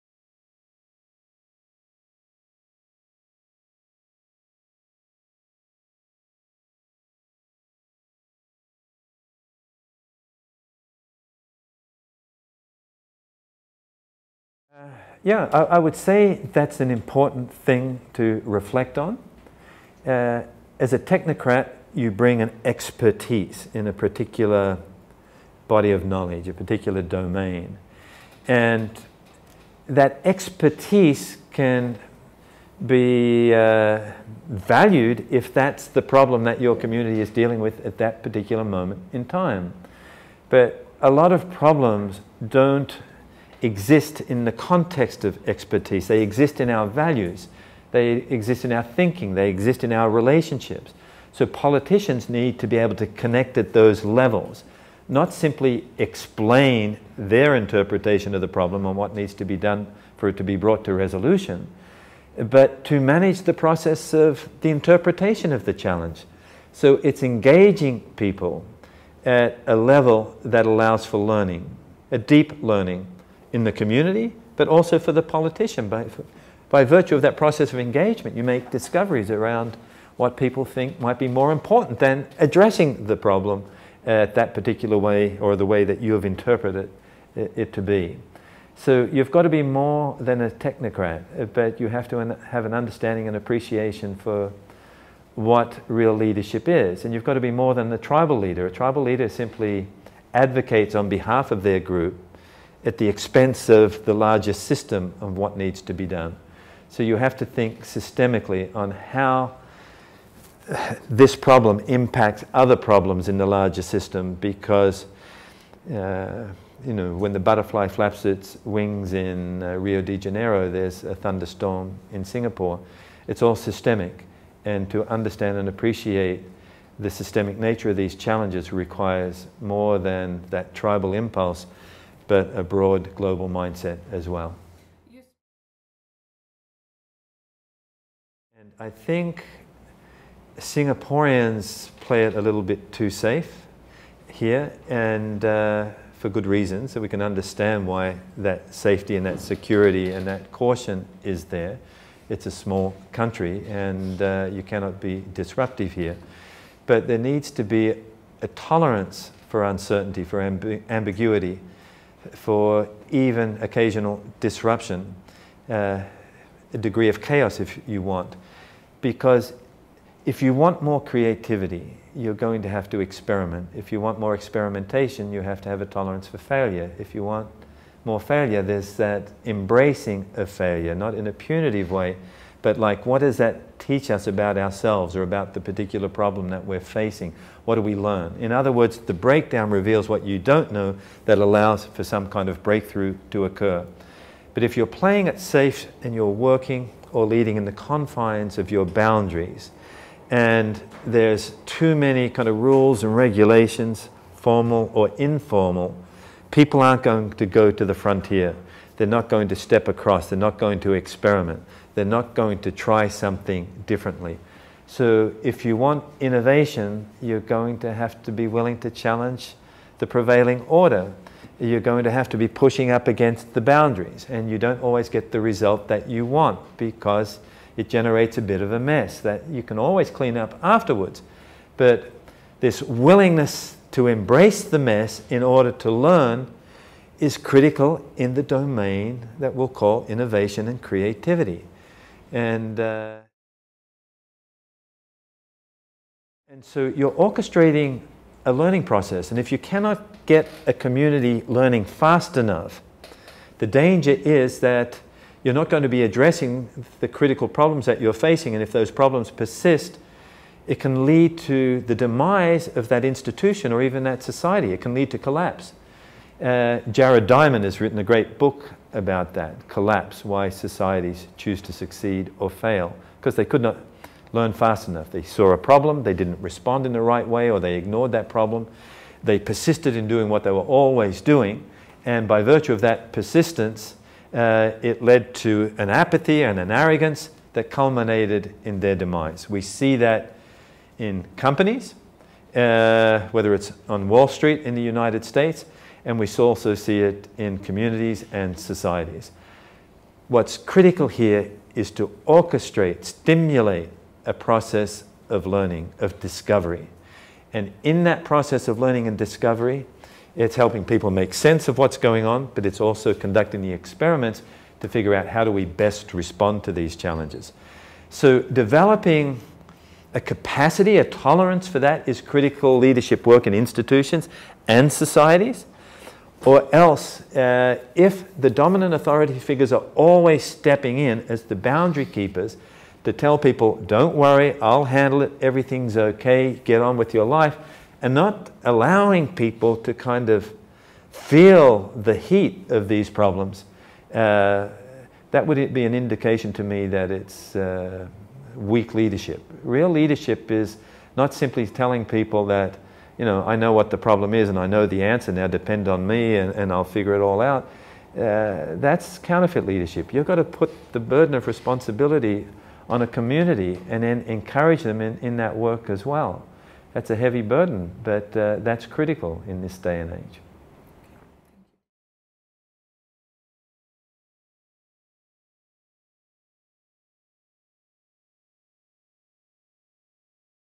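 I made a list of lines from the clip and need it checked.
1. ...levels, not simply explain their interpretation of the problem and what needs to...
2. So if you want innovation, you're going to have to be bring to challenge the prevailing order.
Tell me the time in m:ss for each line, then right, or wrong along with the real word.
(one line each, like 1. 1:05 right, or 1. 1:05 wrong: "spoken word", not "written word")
1. 0:54 right
2. 3:34 wrong: "willing", not "bring".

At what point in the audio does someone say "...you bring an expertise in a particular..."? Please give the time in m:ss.
0:21.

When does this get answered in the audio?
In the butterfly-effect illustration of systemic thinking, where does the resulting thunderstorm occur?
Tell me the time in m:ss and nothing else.
2:02.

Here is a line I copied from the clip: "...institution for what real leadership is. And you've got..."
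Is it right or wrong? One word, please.
wrong.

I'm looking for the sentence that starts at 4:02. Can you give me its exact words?
And, uh, and so you're orchestrating a learning process.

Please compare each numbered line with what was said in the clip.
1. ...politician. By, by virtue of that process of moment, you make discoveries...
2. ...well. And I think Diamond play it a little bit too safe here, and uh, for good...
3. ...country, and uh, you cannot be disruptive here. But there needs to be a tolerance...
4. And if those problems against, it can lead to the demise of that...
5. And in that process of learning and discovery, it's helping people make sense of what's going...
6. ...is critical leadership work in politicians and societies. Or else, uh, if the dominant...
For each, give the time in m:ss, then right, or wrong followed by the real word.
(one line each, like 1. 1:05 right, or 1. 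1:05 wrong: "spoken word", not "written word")
1. 1:15 wrong: "engagement", not "moment"
2. 2:14 wrong: "Singaporeans", not "Diamond"
3. 2:33 right
4. 4:18 wrong: "persist", not "against"
5. 5:07 right
6. 5:22 wrong: "institutions", not "politicians".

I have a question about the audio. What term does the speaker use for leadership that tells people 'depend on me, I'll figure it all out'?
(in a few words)
counterfeit leadership.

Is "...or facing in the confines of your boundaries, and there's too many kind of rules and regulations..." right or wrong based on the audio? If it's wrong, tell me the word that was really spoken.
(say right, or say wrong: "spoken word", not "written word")
wrong: "leading", not "facing".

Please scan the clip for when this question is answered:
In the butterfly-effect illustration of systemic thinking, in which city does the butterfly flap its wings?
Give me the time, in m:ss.
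1:59.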